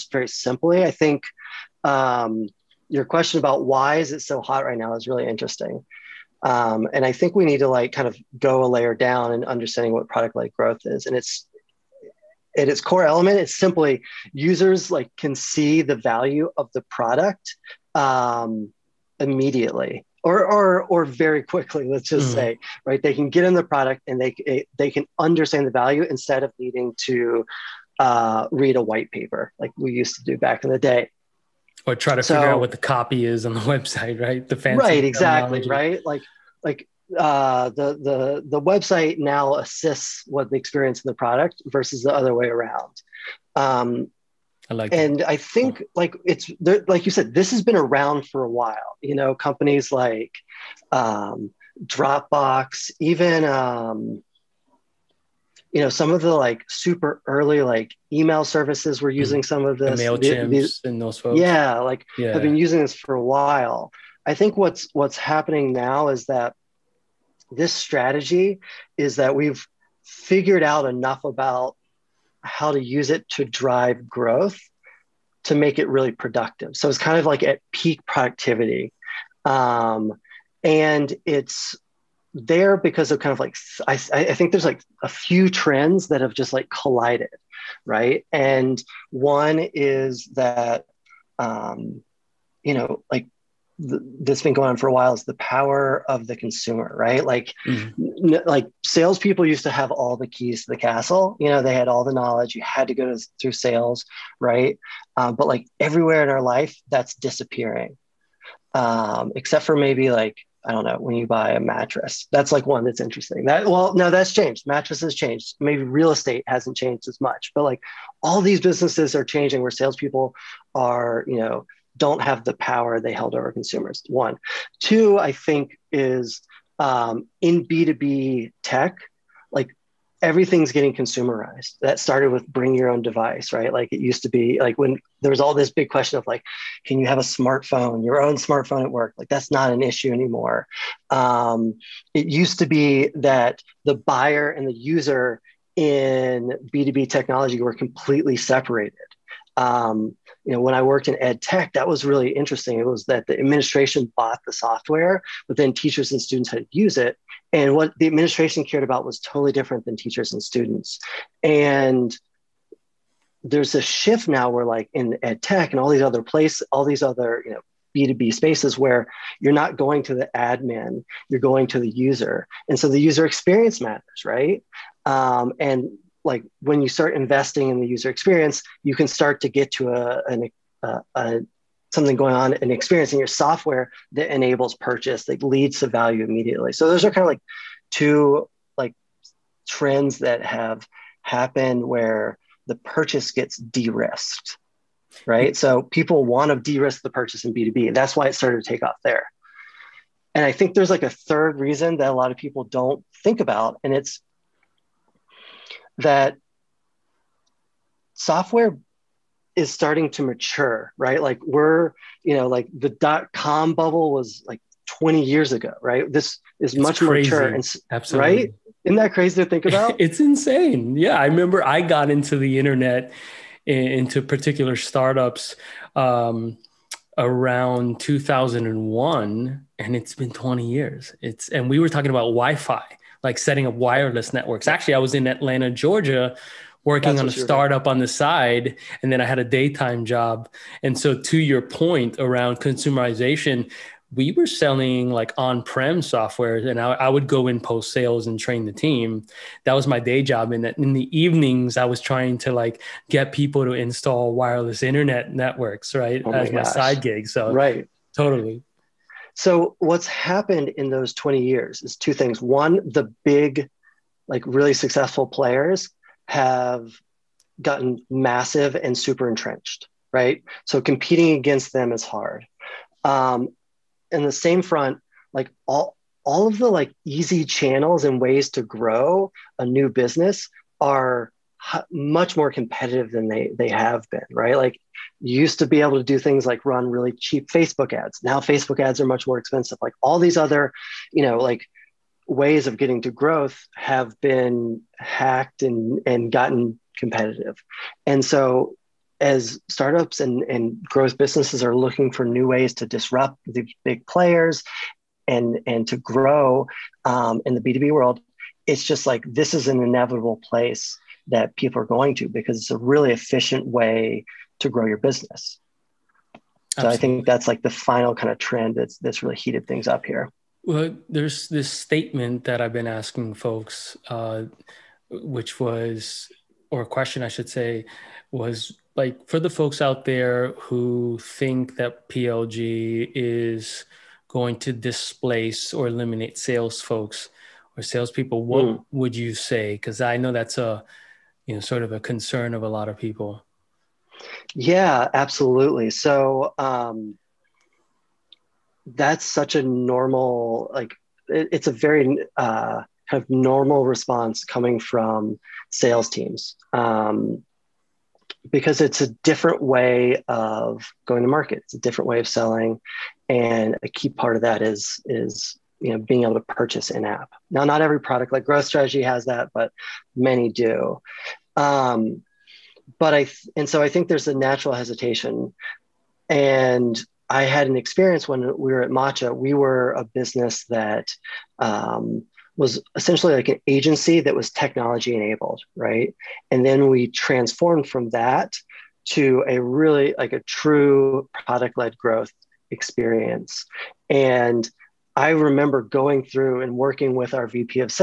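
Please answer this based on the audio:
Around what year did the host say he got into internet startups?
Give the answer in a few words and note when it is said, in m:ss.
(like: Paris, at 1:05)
2001, at 3:47.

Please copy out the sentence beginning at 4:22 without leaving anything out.
One, the big, like really successful players have gotten massive and super entrenched, right?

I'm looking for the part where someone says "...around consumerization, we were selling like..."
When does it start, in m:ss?
4:02.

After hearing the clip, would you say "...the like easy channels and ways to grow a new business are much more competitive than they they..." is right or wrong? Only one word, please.
right.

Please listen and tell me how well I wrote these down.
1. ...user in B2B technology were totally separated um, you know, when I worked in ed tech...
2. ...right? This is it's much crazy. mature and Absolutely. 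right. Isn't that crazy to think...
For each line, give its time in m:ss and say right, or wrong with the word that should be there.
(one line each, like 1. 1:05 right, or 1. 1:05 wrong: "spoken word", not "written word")
1. 2:24 wrong: "completely", not "totally"
2. 3:35 right.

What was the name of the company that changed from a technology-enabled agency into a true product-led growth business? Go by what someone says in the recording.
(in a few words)
Matcha.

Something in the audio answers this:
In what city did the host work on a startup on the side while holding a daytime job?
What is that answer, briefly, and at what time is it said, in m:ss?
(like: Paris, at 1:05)
Atlanta, Georgia, at 3:55.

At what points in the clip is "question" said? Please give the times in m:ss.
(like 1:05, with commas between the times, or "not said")
0:03, 2:15, 5:26.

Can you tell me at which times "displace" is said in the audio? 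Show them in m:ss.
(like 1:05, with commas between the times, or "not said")
5:34.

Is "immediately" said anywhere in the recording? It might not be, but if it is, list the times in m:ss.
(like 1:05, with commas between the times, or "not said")
0:19, 3:06.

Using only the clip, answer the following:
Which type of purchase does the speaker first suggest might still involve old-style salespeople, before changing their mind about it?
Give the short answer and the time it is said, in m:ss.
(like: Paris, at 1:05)
mattress, at 1:51.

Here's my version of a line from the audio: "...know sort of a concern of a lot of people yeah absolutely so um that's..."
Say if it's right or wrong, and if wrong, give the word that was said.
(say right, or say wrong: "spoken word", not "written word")
right.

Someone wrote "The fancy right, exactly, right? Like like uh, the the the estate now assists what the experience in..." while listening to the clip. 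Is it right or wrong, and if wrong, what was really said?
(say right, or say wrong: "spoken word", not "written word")
wrong: "website", not "estate".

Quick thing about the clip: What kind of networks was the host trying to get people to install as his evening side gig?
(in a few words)
wireless internet networks.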